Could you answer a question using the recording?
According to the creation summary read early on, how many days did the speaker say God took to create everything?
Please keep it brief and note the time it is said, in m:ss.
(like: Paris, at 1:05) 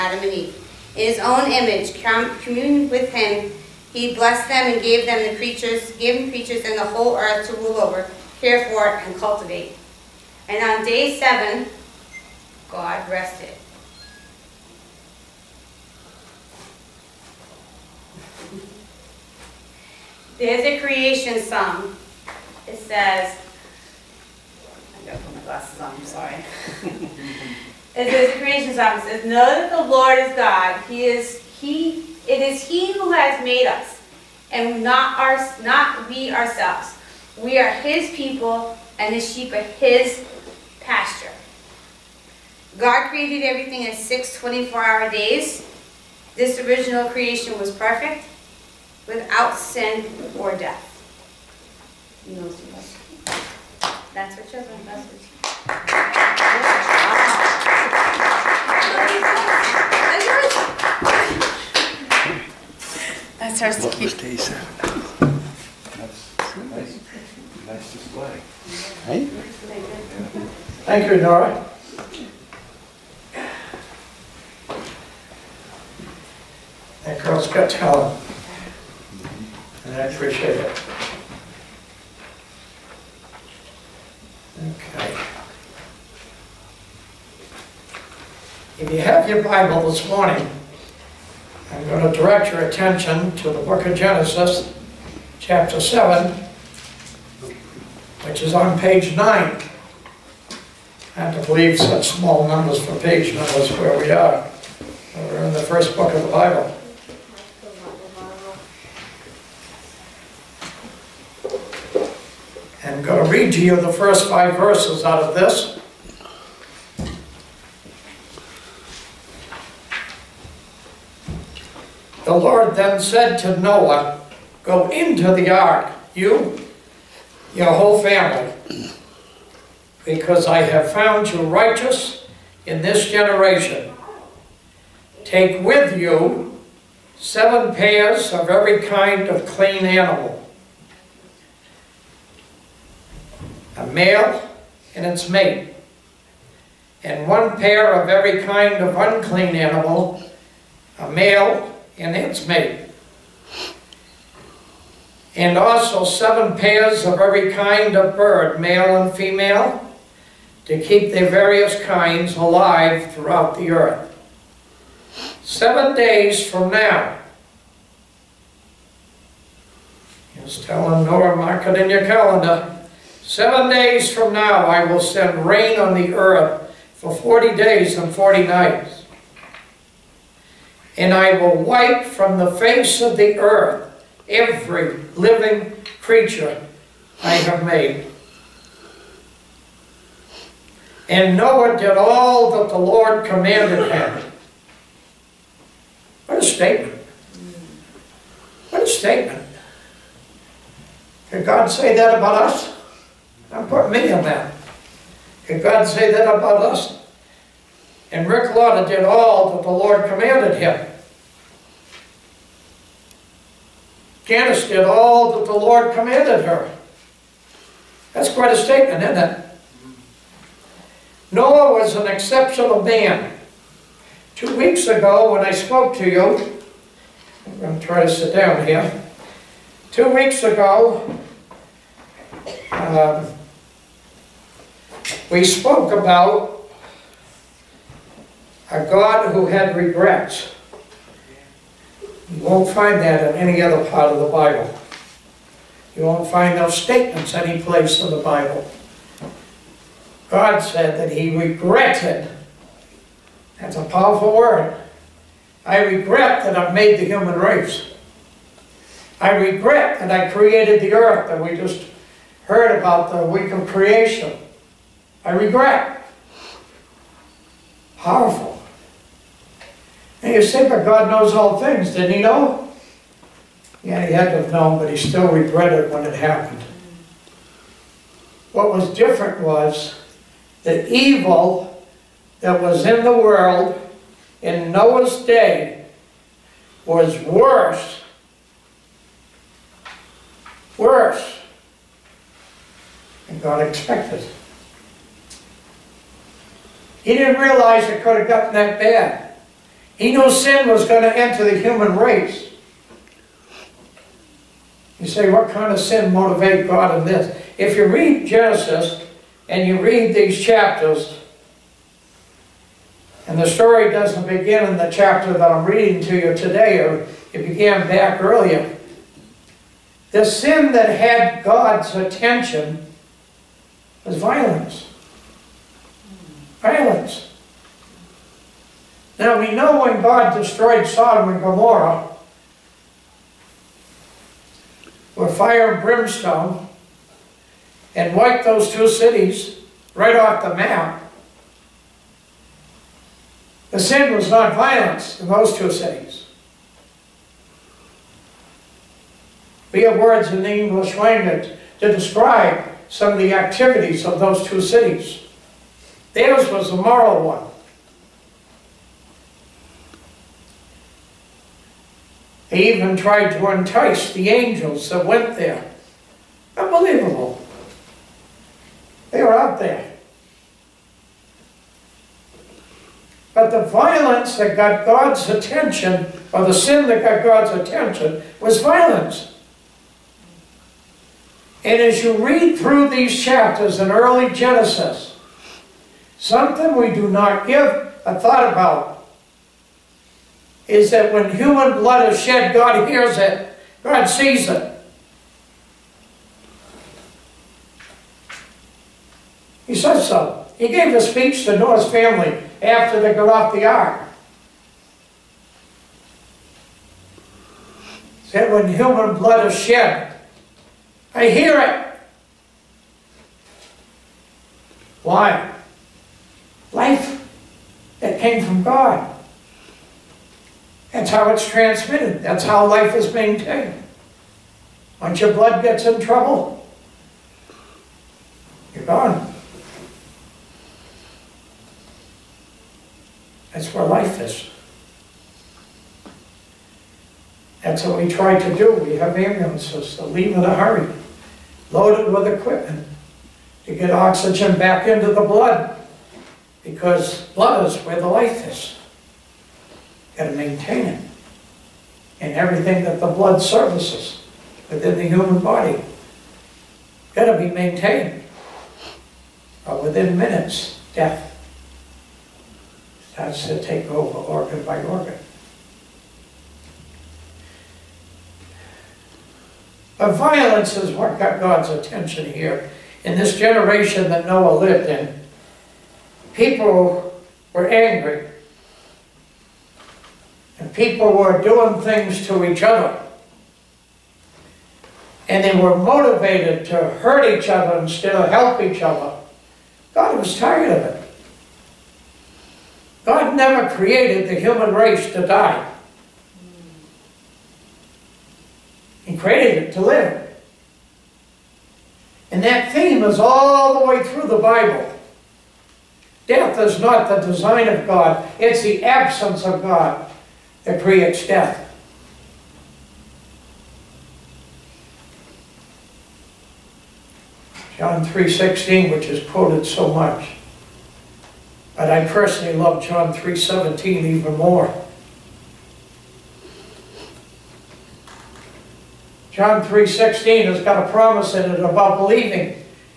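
6, at 0:43.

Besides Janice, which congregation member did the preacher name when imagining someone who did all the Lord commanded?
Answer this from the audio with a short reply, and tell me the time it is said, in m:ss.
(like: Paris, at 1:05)
Rick Lauder, at 3:28.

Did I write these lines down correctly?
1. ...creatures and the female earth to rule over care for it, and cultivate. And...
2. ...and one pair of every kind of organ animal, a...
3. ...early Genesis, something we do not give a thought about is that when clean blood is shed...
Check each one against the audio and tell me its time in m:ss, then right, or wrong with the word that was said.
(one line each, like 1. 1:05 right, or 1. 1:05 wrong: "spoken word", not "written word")
1. 0:06 wrong: "whole", not "female"
2. 2:27 wrong: "unclean", not "organ"
3. 6:23 wrong: "human", not "clean".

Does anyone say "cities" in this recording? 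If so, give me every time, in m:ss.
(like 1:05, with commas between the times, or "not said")
5:38, 5:45, 5:54.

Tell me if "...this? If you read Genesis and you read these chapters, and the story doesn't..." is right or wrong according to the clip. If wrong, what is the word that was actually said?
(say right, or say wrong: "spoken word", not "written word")
right.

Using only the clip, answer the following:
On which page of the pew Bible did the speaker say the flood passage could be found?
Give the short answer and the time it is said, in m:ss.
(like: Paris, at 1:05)
9, at 1:38.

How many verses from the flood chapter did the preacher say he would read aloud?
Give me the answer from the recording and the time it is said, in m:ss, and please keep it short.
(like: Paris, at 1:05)
5, at 1:54.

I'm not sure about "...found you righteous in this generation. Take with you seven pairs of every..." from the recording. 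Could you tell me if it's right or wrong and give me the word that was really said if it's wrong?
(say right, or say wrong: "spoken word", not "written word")
right.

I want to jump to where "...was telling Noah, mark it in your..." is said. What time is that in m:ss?
2:50.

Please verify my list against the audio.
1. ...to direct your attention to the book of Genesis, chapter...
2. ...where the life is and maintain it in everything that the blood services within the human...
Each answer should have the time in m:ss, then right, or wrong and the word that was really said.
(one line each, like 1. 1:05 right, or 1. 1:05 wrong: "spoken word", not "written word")
1. 1:32 right
2. 7:27 right.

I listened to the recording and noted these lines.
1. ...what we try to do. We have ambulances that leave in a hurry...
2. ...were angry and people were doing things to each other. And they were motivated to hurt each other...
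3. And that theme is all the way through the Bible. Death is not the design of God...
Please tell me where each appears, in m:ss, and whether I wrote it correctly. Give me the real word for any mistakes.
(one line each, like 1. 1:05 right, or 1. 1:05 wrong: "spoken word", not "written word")
1. 7:17 right
2. 7:57 right
3. 8:22 right.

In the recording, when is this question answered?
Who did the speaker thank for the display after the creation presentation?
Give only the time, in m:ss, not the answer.
1:11.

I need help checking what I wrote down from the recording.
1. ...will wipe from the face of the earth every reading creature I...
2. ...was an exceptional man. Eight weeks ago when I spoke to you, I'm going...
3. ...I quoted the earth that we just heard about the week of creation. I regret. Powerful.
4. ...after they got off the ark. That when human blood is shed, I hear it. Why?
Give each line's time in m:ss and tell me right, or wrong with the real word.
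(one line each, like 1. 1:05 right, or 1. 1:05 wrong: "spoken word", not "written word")
1. 3:01 wrong: "living", not "reading"
2. 3:41 wrong: "Two", not "Eight"
3. 4:20 wrong: "created", not "quoted"
4. 6:42 right.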